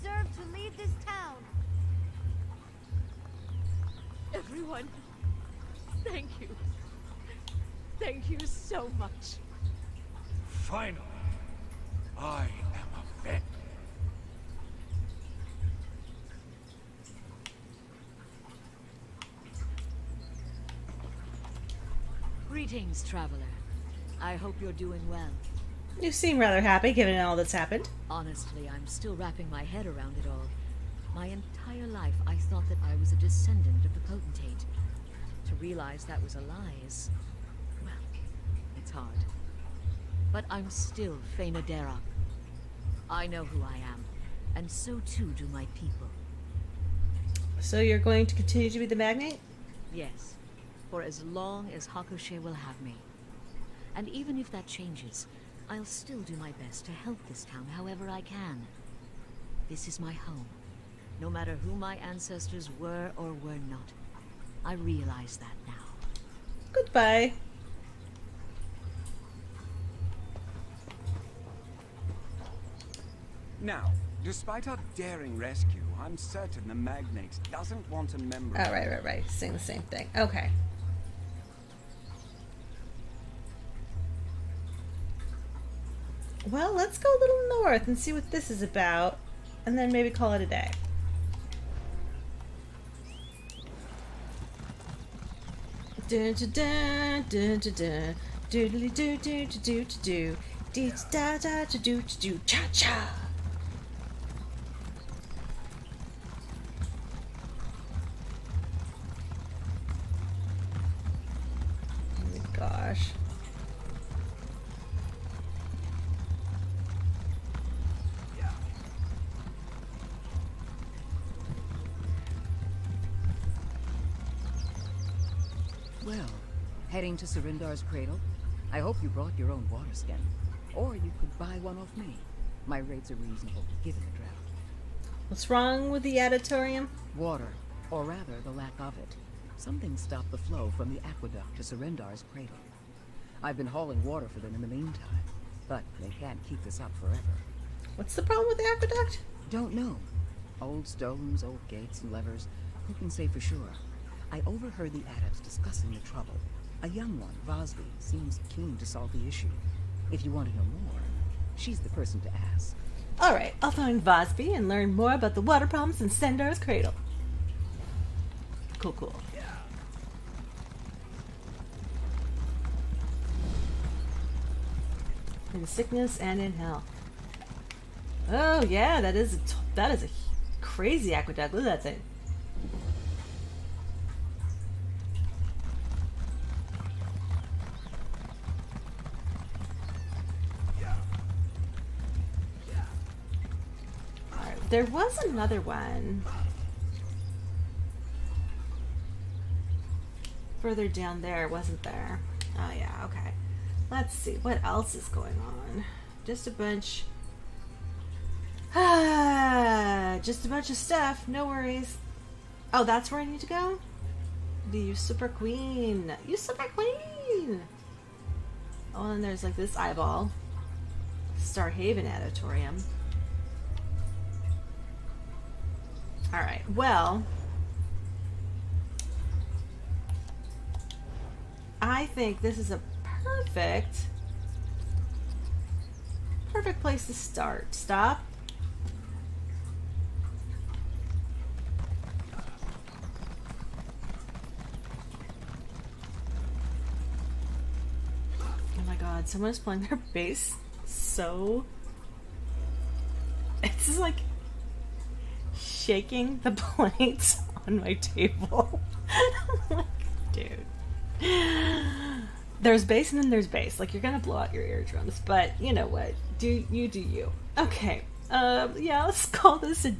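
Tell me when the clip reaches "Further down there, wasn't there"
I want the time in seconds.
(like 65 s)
200 s.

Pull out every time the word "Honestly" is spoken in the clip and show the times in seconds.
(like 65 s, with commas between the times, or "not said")
28 s.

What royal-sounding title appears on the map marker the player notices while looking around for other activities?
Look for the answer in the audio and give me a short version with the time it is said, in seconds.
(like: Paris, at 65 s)
The Usurper Queen, at 214 s.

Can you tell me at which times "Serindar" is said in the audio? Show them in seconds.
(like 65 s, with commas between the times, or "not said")
127 s, 141 s.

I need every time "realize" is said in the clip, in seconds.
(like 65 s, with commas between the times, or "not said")
35 s, 64 s.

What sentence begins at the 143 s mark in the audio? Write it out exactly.
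I've been hauling water for them in the meantime, but they can't keep this up forever.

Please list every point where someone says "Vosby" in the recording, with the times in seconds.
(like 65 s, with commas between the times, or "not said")
157 s, 164 s.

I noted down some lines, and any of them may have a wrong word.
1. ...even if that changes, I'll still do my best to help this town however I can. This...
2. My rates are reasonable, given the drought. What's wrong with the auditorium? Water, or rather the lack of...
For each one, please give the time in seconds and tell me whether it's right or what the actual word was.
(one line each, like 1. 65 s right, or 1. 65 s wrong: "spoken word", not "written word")
1. 54 s right
2. 132 s right.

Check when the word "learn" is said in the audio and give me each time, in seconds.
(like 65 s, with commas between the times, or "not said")
164 s.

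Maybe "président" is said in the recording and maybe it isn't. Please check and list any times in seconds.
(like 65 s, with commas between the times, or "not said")
not said.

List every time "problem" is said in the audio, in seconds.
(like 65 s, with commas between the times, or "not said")
148 s, 165 s.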